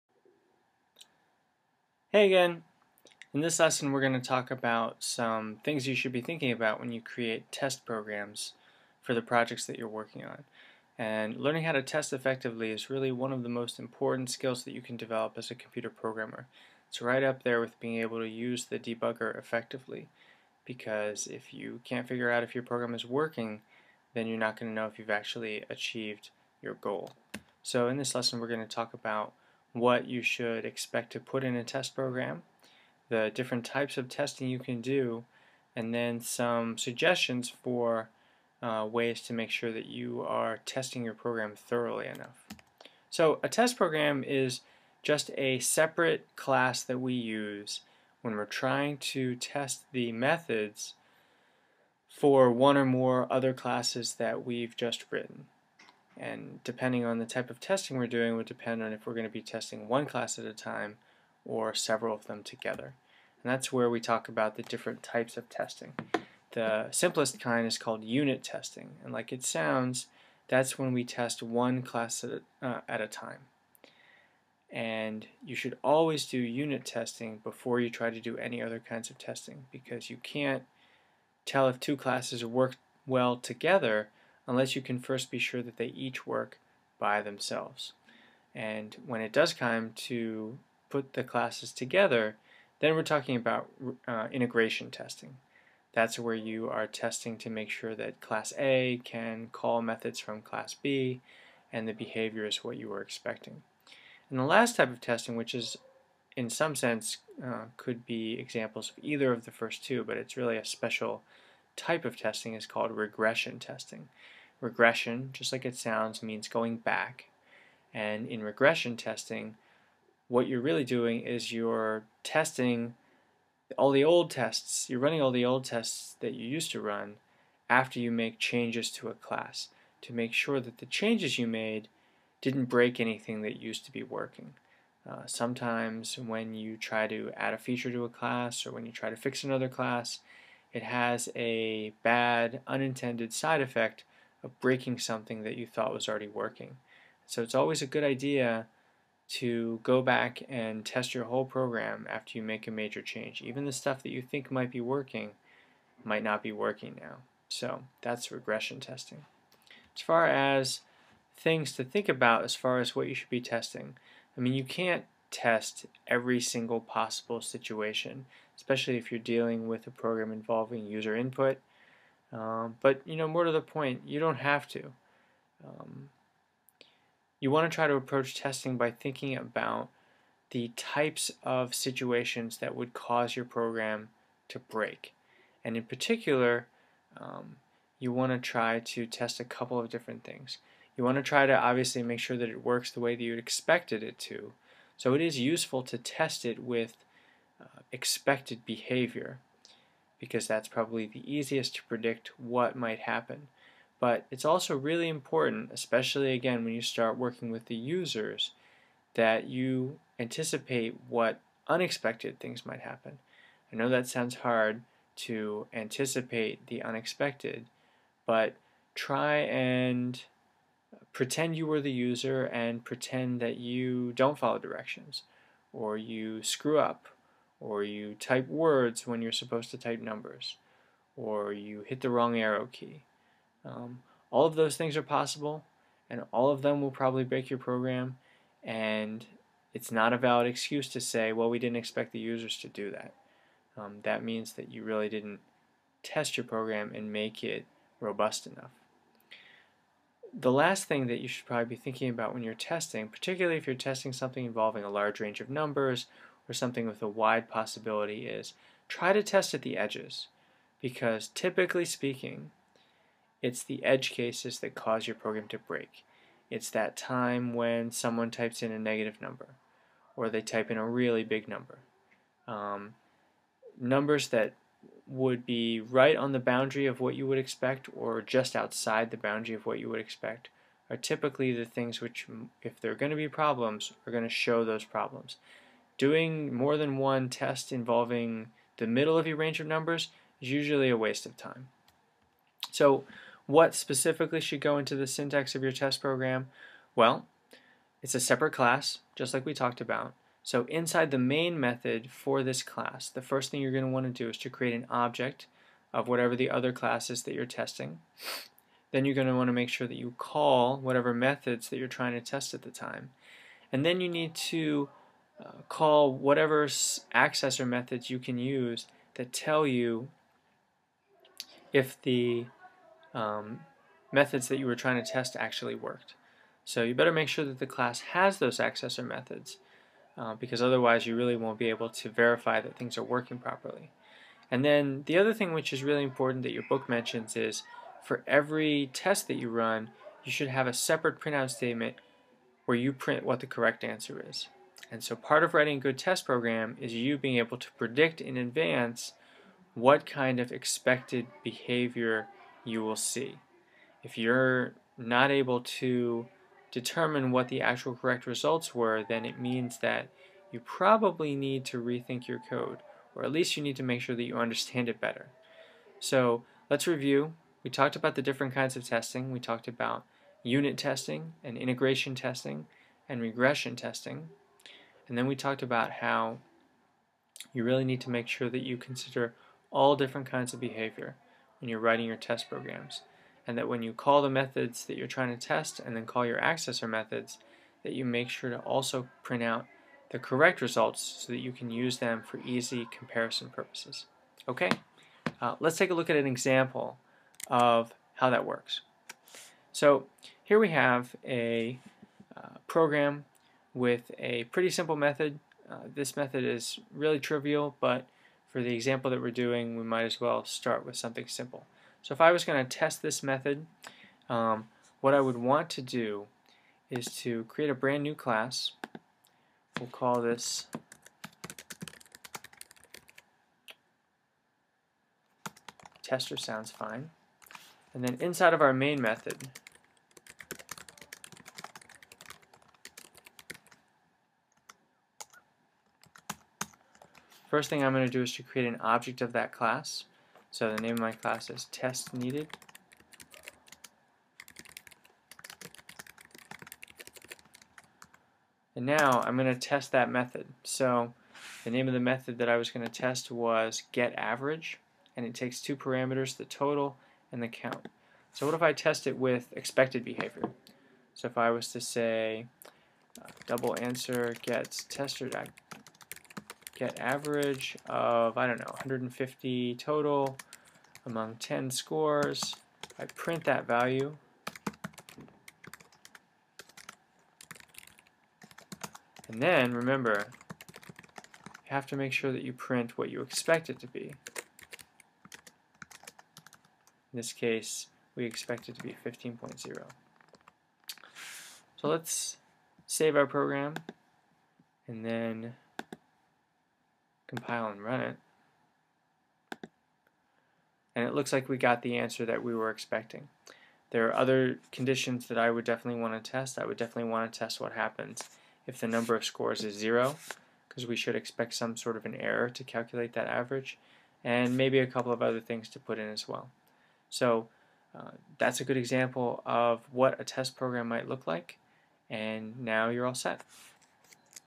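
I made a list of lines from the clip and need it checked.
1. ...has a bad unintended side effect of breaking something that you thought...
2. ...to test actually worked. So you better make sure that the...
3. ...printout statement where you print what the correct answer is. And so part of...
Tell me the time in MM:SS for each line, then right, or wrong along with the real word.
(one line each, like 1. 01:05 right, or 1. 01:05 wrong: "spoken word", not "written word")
1. 02:20 right
2. 05:25 right
3. 05:41 right.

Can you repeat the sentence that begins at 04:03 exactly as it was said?
Um, that means that you really didn't test your program and make it robust enough.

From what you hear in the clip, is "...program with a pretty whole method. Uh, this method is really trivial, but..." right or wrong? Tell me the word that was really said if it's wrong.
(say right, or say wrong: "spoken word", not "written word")
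wrong: "simple", not "whole".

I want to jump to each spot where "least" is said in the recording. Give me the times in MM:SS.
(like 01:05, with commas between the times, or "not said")
06:03.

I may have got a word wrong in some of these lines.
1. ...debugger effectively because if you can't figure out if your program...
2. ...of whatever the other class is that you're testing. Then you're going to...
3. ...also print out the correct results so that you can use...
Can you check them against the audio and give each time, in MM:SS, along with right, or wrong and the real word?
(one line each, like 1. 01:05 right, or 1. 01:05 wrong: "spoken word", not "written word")
1. 00:18 right
2. 05:05 right
3. 06:28 right.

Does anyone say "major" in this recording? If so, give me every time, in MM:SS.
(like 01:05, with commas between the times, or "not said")
02:32.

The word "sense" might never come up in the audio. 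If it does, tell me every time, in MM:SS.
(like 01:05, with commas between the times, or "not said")
01:46.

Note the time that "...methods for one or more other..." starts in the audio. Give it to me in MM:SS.
00:50.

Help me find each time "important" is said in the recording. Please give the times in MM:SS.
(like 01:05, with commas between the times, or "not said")
00:13, 03:25, 05:36.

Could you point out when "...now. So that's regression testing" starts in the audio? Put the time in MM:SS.
02:37.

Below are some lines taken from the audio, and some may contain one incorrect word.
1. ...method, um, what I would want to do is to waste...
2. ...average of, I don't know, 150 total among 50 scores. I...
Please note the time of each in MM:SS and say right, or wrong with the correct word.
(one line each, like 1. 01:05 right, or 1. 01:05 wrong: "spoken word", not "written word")
1. 06:53 wrong: "create", not "waste"
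2. 07:46 wrong: "10", not "50".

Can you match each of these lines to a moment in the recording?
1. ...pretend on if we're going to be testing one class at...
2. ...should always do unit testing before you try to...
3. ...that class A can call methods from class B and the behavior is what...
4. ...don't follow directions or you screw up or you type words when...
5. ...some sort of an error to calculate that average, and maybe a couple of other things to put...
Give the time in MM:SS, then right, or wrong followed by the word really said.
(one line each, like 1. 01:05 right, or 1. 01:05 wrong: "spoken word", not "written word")
1. 00:58 wrong: "depend", not "pretend"
2. 01:15 right
3. 01:37 right
4. 03:44 right
5. 08:31 right.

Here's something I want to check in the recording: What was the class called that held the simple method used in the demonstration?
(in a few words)
test needed.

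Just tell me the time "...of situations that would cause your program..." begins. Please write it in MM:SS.
03:01.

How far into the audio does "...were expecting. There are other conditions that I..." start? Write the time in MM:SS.
08:22.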